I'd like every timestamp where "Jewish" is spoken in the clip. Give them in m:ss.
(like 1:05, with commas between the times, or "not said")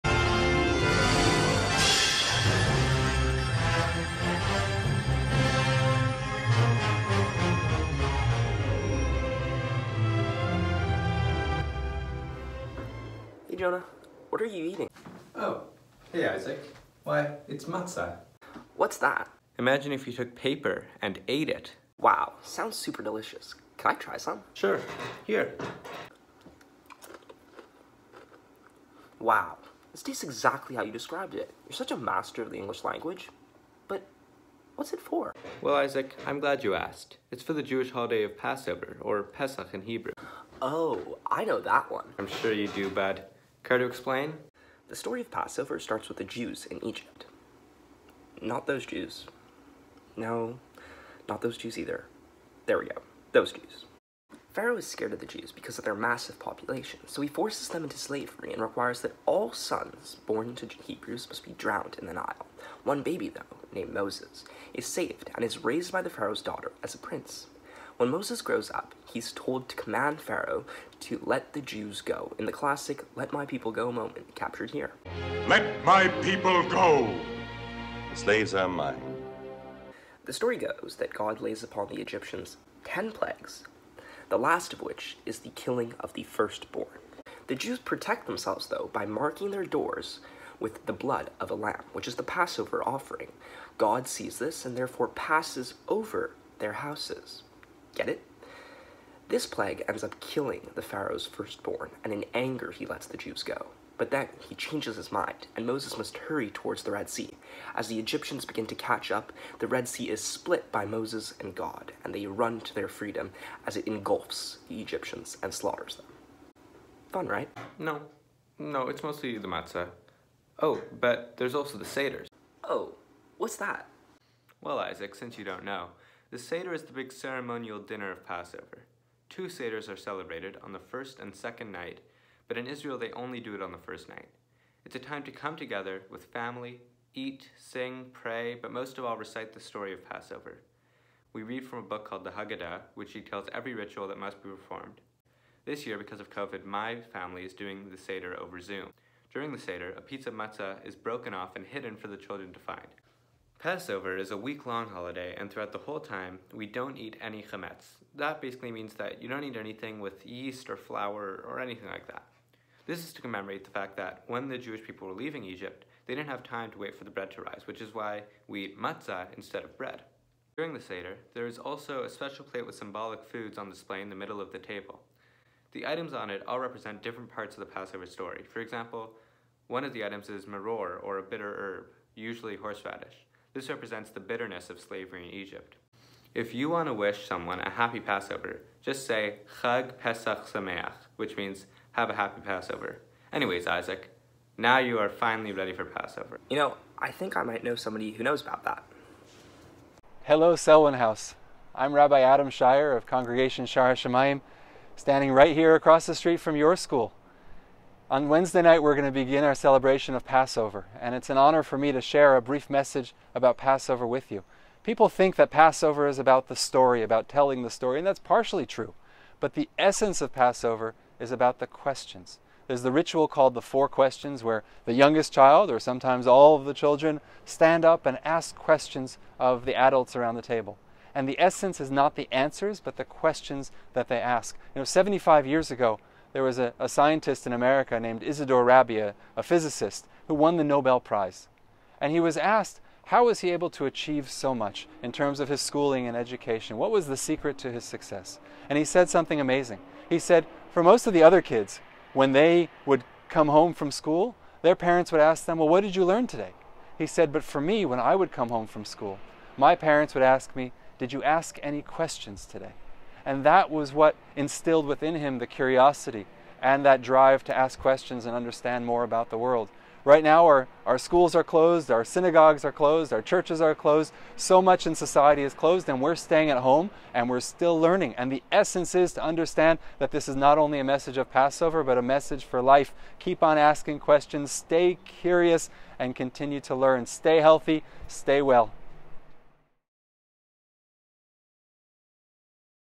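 0:37, 2:44.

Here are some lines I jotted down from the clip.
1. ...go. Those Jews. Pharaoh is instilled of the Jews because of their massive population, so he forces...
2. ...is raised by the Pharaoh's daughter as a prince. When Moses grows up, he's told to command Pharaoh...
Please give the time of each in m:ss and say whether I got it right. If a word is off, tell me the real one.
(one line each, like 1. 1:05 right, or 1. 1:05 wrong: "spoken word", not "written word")
1. 0:52 wrong: "scared", not "instilled"
2. 1:05 right.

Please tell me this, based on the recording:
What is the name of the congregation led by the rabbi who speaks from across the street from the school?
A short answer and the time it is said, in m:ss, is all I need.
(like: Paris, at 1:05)
Congregation Shaar Hashomayim, at 3:23.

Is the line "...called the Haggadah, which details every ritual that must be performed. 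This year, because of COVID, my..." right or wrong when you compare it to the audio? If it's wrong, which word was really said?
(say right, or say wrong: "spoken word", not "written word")
right.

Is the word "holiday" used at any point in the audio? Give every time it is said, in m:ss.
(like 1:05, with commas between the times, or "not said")
0:37, 2:34.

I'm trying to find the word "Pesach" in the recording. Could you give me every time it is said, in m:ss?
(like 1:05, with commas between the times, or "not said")
0:39, 3:09.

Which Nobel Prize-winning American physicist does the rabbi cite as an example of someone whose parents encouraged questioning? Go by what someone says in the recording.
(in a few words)
Isidor Rabi.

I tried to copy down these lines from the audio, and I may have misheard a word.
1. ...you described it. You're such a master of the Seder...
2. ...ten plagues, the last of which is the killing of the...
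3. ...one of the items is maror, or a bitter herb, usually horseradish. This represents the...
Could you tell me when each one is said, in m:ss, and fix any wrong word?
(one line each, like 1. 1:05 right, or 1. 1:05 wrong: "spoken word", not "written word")
1. 0:30 wrong: "English", not "Seder"
2. 1:22 right
3. 2:59 right.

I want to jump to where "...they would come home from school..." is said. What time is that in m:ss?
4:12.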